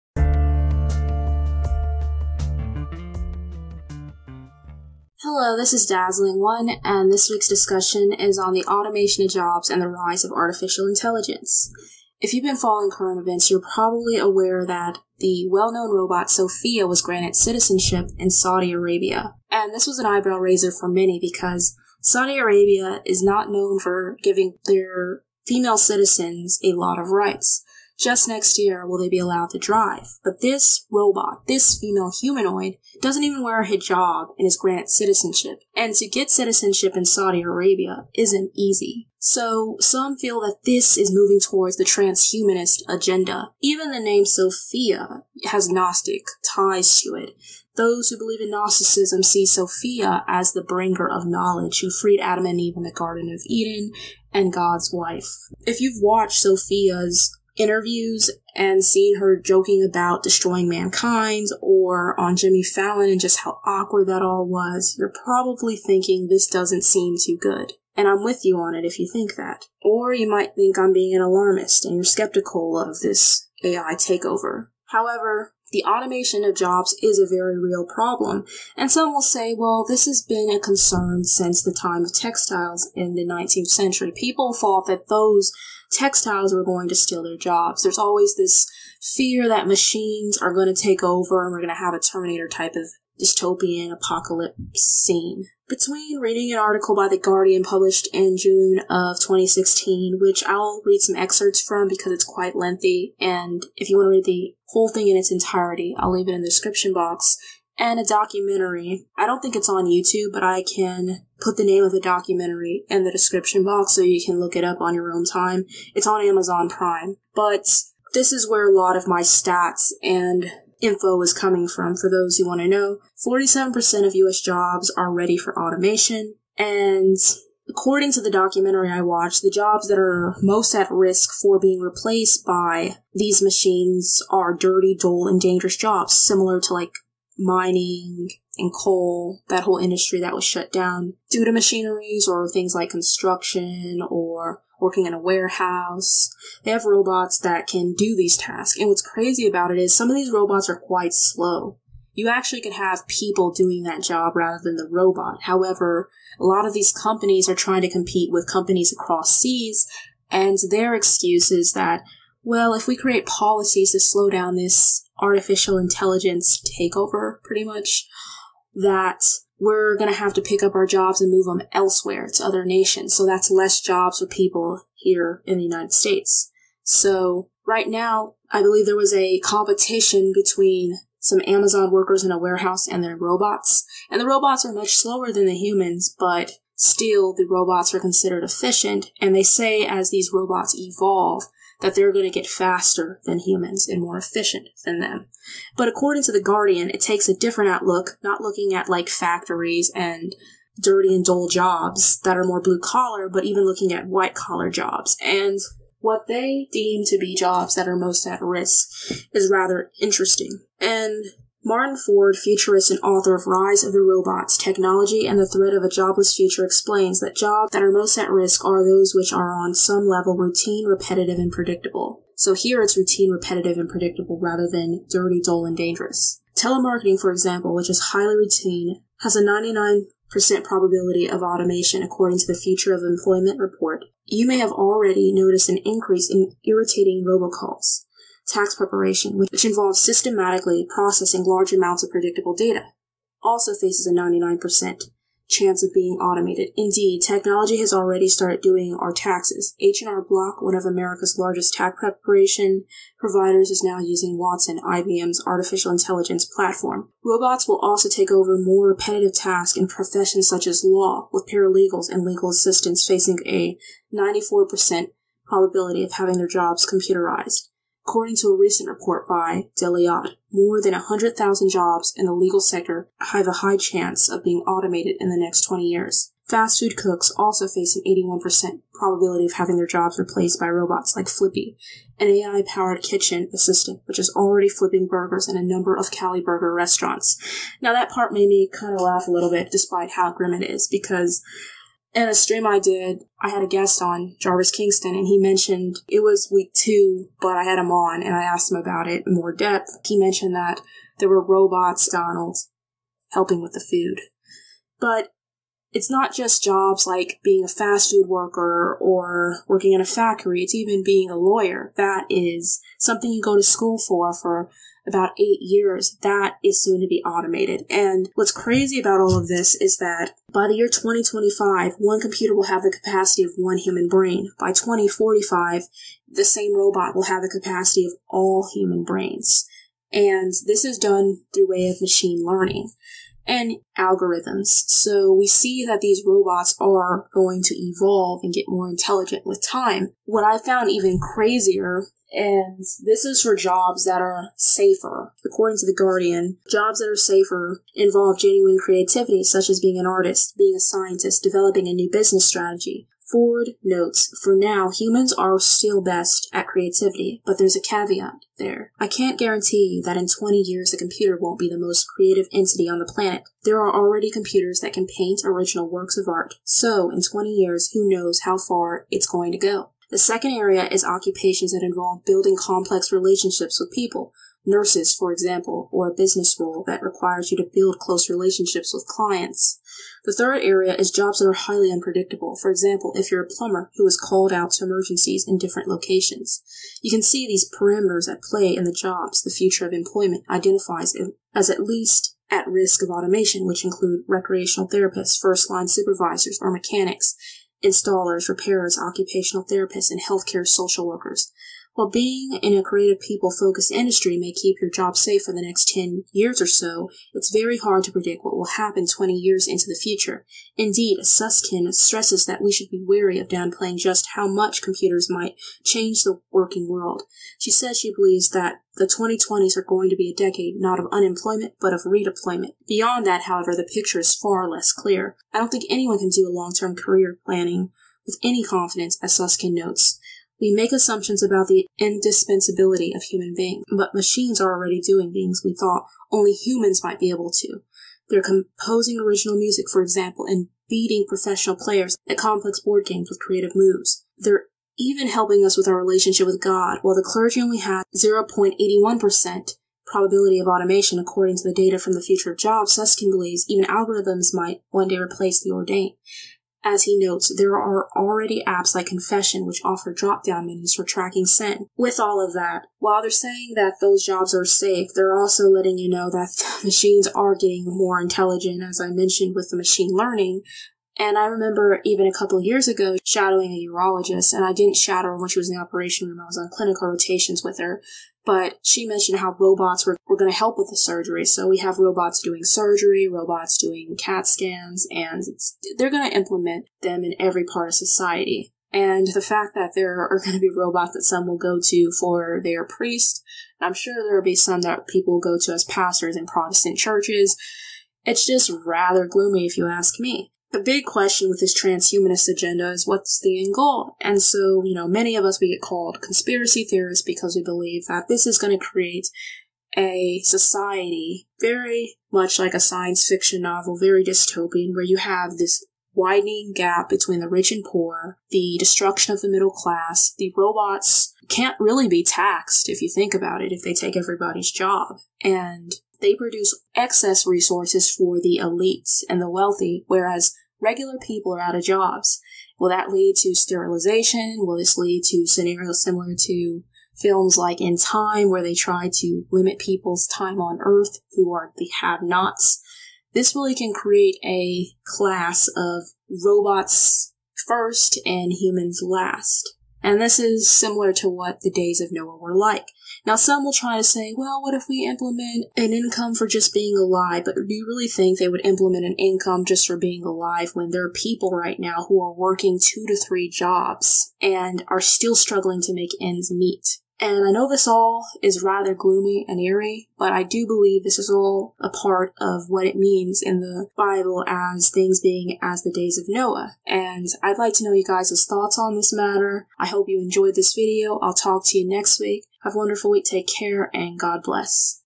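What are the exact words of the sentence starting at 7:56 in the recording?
I was on clinical rotations with her, but she mentioned how robots were, were going to help with the surgery.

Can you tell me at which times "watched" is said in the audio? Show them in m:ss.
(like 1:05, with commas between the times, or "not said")
0:56, 2:09.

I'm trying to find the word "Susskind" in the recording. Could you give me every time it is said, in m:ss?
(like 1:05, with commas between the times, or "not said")
6:51, 7:09, 7:32.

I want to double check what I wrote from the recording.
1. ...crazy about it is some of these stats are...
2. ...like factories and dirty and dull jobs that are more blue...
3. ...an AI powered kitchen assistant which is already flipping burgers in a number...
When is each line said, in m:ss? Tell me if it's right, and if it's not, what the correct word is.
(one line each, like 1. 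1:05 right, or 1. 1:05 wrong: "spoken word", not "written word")
1. 2:29 wrong: "robots", not "stats"
2. 3:18 right
3. 4:42 right.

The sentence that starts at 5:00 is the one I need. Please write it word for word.
He mentioned that there were robots, Donald's, helping with the food.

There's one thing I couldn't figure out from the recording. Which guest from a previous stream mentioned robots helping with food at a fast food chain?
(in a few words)
Jarvis Kingston.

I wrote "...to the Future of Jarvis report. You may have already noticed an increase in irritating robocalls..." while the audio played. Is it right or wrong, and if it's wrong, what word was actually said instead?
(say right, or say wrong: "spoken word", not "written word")
wrong: "Employment", not "Jarvis".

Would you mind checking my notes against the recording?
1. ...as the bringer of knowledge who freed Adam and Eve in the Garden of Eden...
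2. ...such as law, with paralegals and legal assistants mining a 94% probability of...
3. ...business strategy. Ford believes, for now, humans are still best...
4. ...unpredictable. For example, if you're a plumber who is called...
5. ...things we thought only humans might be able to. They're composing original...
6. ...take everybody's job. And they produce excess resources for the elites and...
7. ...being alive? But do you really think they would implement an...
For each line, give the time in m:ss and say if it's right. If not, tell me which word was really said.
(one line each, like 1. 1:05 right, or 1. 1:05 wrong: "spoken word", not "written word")
1. 0:50 right
2. 4:20 wrong: "facing", not "mining"
3. 5:52 wrong: "notes", not "believes"
4. 6:21 right
5. 7:15 right
6. 8:43 right
7. 9:16 right.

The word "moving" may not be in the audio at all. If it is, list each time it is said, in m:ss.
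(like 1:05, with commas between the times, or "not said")
0:41.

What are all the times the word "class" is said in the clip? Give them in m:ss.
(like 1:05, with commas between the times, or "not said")
8:39, 9:05.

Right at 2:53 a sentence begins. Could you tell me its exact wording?
So that's less jobs for people here in the United States.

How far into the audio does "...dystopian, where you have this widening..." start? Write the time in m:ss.
8:34.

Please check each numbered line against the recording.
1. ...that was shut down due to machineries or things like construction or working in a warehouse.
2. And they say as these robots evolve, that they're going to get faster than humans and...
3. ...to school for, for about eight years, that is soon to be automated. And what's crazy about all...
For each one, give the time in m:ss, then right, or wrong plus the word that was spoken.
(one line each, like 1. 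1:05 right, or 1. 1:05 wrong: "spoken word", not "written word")
1. 2:20 right
2. 3:09 right
3. 5:13 right.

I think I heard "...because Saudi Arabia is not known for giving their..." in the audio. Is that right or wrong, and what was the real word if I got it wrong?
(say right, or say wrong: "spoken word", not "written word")
right.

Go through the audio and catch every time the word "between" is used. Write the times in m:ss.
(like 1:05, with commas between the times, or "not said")
1:35, 3:00, 8:37.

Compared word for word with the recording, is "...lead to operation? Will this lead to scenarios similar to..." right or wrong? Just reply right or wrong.
wrong.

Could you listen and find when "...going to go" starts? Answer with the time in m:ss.
6:09.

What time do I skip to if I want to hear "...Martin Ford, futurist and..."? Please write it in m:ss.
3:31.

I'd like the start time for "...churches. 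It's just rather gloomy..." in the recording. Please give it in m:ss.
8:16.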